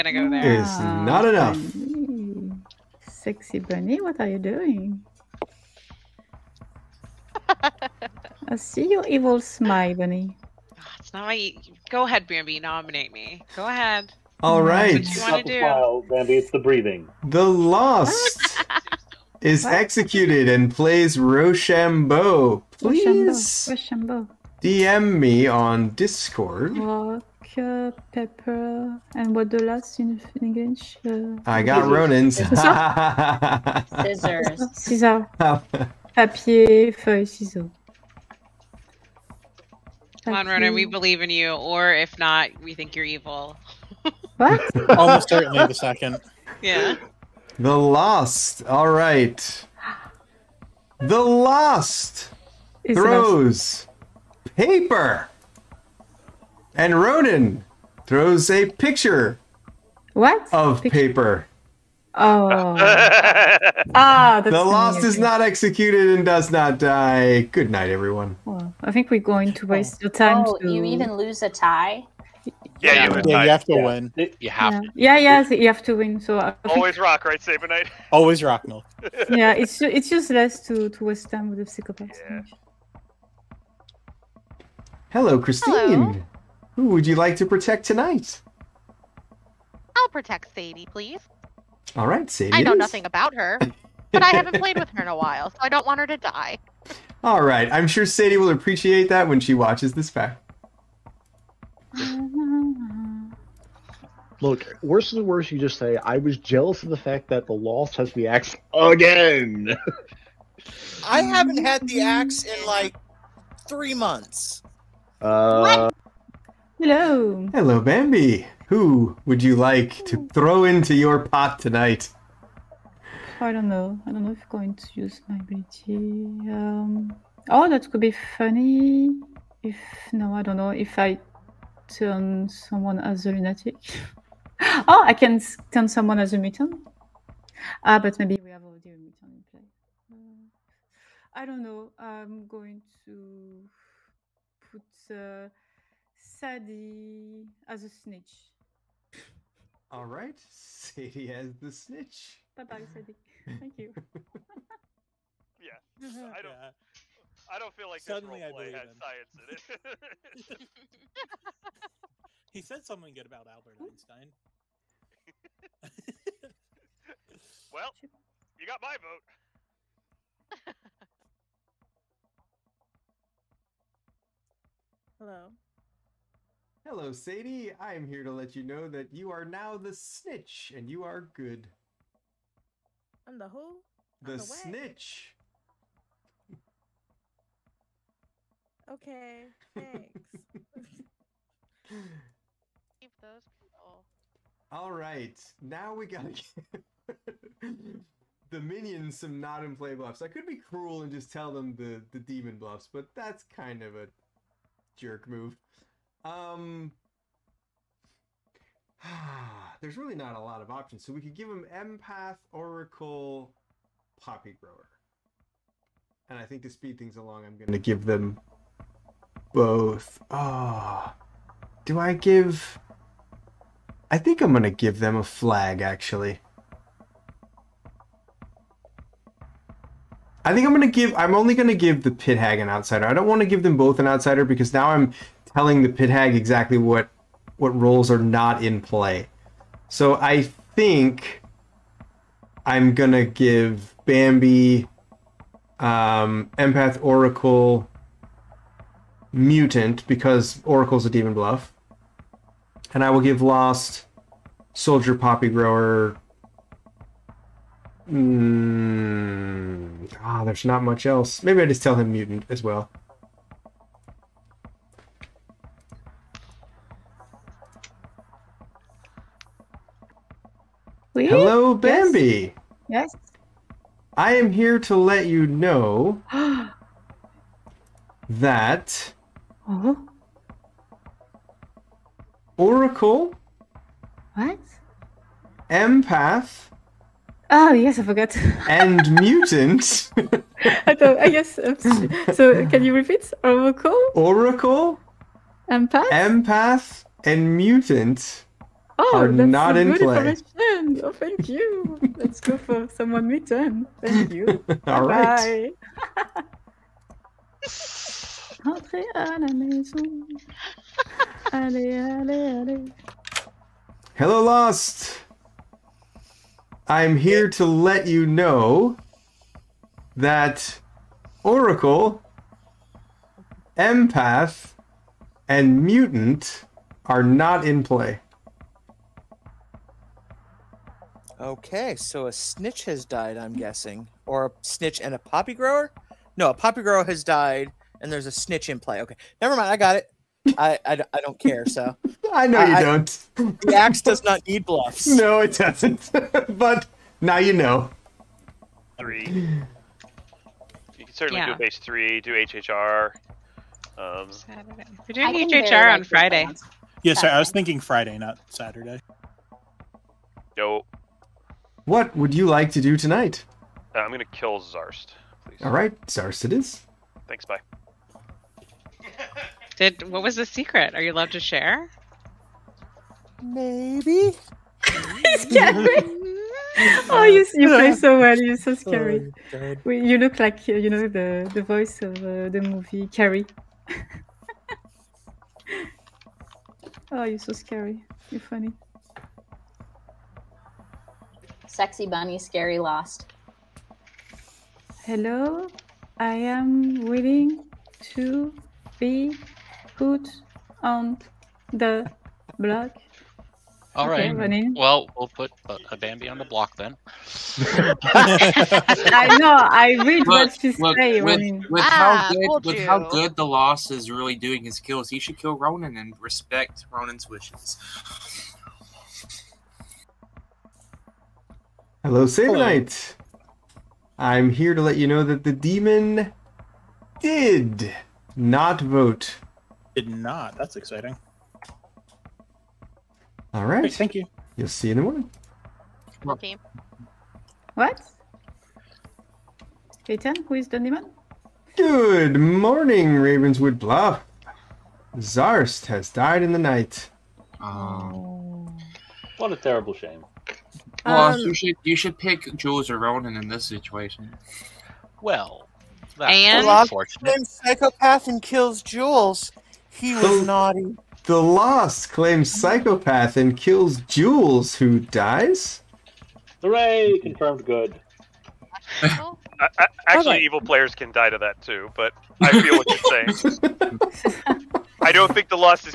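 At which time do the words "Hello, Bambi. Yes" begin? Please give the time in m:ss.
4:31.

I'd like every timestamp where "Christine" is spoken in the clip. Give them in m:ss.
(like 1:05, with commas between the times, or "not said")
1:25.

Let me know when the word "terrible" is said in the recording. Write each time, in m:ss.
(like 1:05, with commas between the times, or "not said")
7:29.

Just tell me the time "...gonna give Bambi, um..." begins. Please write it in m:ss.
4:02.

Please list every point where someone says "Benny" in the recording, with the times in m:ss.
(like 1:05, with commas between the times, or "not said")
0:03, 0:09.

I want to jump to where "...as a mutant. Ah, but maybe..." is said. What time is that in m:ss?
2:16.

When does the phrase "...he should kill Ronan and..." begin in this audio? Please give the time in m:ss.
6:55.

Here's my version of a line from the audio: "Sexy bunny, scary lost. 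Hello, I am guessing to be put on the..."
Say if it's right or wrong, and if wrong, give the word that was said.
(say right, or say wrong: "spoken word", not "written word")
wrong: "willing", not "guessing".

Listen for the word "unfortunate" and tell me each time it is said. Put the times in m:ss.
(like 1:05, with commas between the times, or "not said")
7:36.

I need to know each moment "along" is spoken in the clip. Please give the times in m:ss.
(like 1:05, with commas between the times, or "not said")
3:37.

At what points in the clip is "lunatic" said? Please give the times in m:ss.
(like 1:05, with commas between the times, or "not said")
2:13.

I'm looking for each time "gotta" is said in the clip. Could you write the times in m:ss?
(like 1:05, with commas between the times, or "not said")
3:16.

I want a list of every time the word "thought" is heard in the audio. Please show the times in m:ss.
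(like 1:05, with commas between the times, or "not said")
4:50.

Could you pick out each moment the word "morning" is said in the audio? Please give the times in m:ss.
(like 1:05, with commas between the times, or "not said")
7:15, 7:22.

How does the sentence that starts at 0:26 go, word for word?
Rock, uh, pepper, and what the last in English?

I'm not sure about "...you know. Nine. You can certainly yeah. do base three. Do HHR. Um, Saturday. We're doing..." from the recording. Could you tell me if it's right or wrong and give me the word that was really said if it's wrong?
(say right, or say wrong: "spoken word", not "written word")
wrong: "Three", not "Nine".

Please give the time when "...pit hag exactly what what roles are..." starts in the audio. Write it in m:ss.
3:55.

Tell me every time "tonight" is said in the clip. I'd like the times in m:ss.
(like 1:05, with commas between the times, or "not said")
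1:27, 2:01, 6:02.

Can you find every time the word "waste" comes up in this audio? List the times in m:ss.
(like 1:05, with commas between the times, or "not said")
1:09, 1:21.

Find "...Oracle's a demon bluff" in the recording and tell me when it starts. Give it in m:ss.
4:10.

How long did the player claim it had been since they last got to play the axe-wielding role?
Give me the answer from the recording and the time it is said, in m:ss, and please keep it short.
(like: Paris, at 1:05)
3 months, at 1:53.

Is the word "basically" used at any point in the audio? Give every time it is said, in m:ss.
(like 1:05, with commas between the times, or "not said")
not said.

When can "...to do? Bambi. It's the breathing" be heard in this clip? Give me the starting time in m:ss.
0:15.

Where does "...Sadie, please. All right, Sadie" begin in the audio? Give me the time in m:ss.
1:30.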